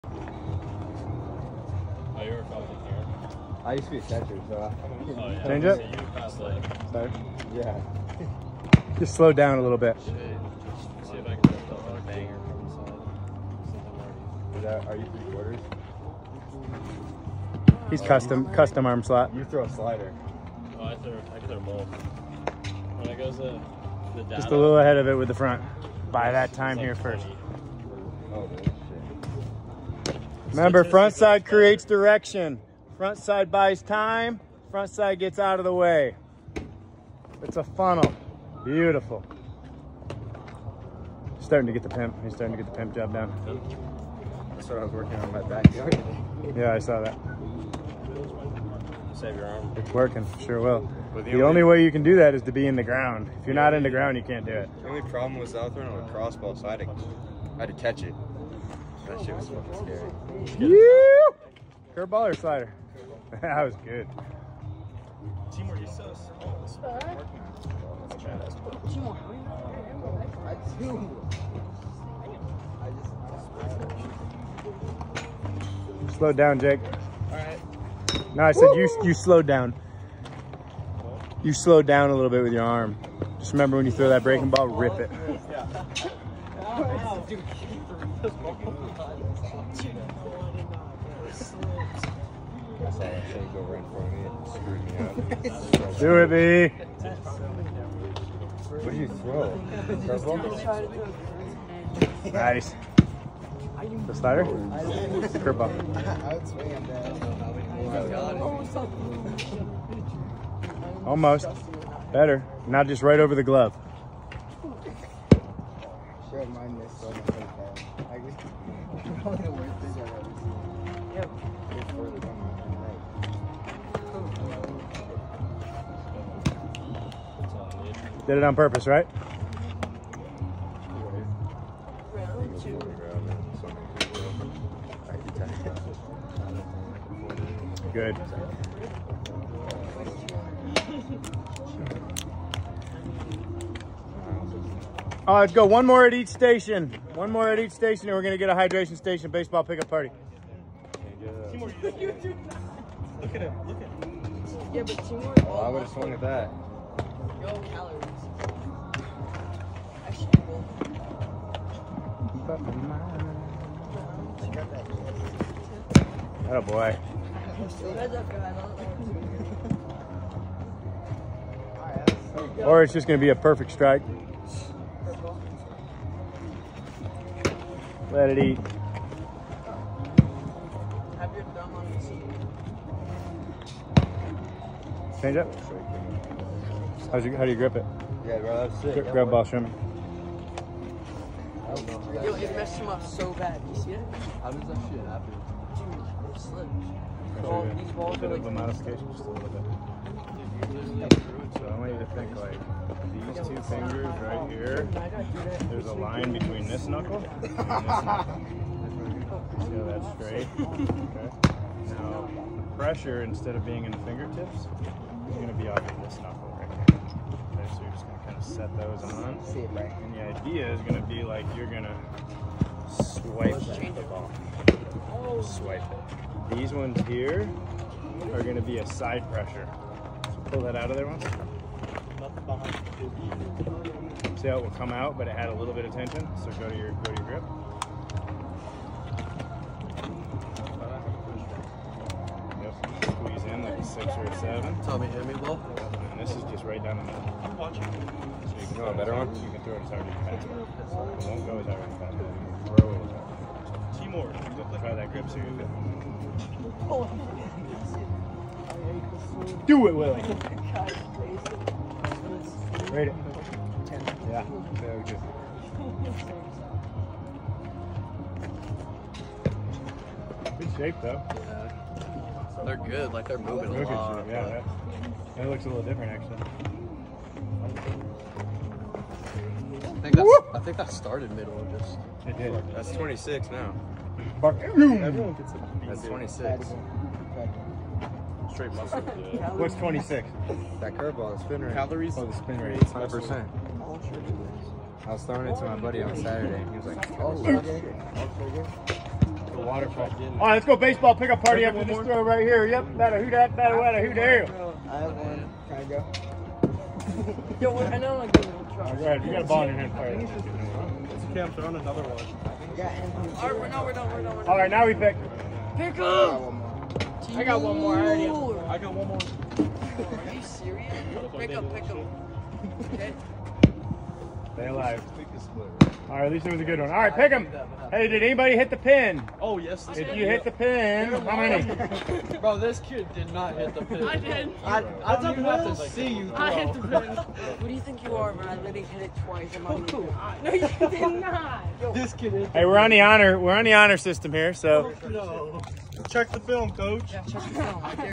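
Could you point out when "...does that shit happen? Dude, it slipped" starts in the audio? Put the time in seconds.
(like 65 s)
194 s.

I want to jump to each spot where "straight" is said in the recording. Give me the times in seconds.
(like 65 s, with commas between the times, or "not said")
210 s, 288 s.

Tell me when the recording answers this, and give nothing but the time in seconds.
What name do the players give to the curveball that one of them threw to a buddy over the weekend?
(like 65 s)
297 s.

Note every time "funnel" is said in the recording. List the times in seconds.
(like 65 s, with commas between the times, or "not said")
37 s.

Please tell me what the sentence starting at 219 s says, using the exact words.
And the idea is going to be like you're going to swipe the ball.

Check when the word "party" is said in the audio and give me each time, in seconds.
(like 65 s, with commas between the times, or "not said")
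149 s, 301 s.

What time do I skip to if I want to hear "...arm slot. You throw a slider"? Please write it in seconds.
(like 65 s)
18 s.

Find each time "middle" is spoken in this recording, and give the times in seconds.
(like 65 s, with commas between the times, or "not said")
247 s, 281 s.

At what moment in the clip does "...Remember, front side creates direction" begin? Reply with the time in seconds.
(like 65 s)
30 s.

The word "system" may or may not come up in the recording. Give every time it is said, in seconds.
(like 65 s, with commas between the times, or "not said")
343 s.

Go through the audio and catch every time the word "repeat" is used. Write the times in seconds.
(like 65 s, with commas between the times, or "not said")
not said.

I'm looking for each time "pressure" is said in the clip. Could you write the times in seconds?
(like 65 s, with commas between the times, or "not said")
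212 s, 229 s.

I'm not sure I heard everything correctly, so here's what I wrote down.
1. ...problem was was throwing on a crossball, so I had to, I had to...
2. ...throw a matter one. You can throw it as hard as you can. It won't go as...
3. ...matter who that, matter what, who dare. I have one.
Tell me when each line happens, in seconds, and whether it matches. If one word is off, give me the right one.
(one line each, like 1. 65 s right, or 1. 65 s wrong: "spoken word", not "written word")
1. 55 s right
2. 248 s wrong: "better", not "matter"
3. 302 s right.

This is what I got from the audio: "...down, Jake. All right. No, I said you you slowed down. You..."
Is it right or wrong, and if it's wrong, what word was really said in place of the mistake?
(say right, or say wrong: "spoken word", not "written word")
right.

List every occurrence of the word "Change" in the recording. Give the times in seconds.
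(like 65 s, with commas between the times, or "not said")
5 s, 185 s.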